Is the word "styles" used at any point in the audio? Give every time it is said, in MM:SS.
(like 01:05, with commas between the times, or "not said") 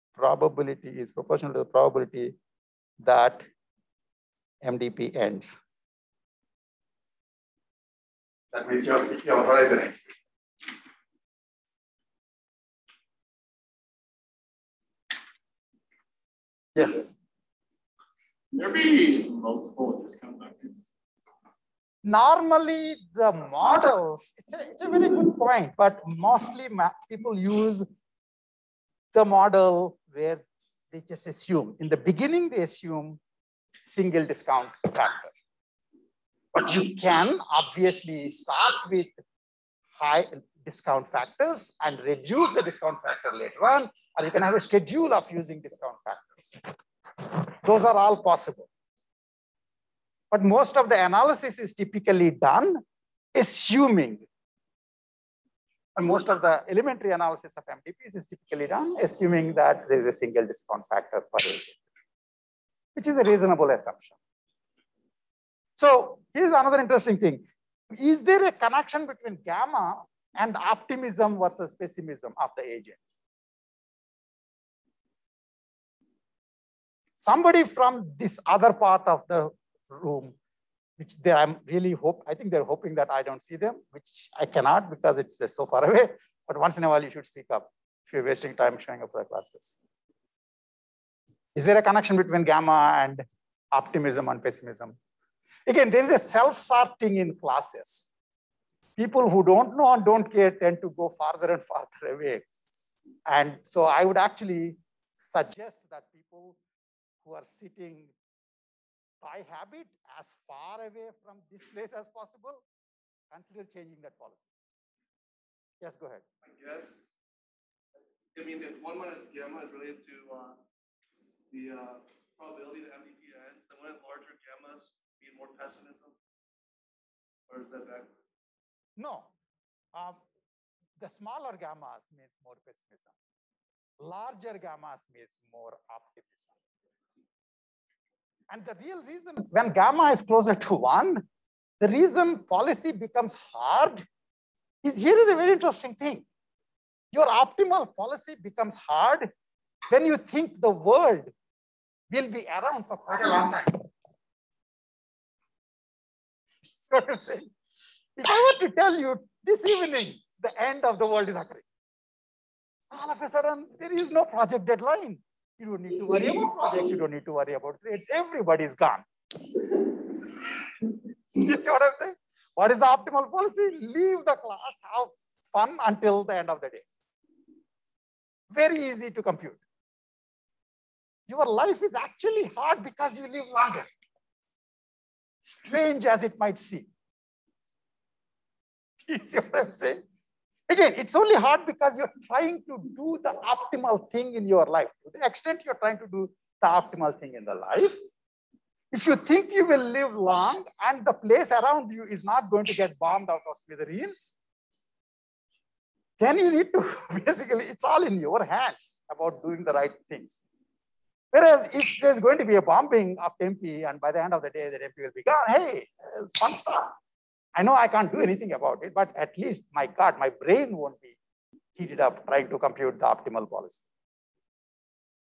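not said.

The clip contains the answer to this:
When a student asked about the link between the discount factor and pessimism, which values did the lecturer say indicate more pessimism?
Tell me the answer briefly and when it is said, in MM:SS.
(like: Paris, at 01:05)
smaller gammas, at 02:11.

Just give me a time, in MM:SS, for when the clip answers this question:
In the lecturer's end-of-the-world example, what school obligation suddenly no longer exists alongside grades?
02:44.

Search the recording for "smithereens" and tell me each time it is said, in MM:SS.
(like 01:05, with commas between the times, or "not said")
03:23.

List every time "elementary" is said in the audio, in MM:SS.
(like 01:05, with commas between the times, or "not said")
00:56.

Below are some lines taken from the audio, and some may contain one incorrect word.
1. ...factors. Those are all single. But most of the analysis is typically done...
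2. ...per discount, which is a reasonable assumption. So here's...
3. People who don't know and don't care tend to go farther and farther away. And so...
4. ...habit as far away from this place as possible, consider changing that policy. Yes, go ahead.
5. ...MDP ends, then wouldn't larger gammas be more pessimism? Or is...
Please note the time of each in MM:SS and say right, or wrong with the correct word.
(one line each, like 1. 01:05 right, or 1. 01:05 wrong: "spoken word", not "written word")
1. 00:46 wrong: "possible", not "single"
2. 01:01 wrong: "agent", not "discount"
3. 01:38 right
4. 01:49 right
5. 02:02 right.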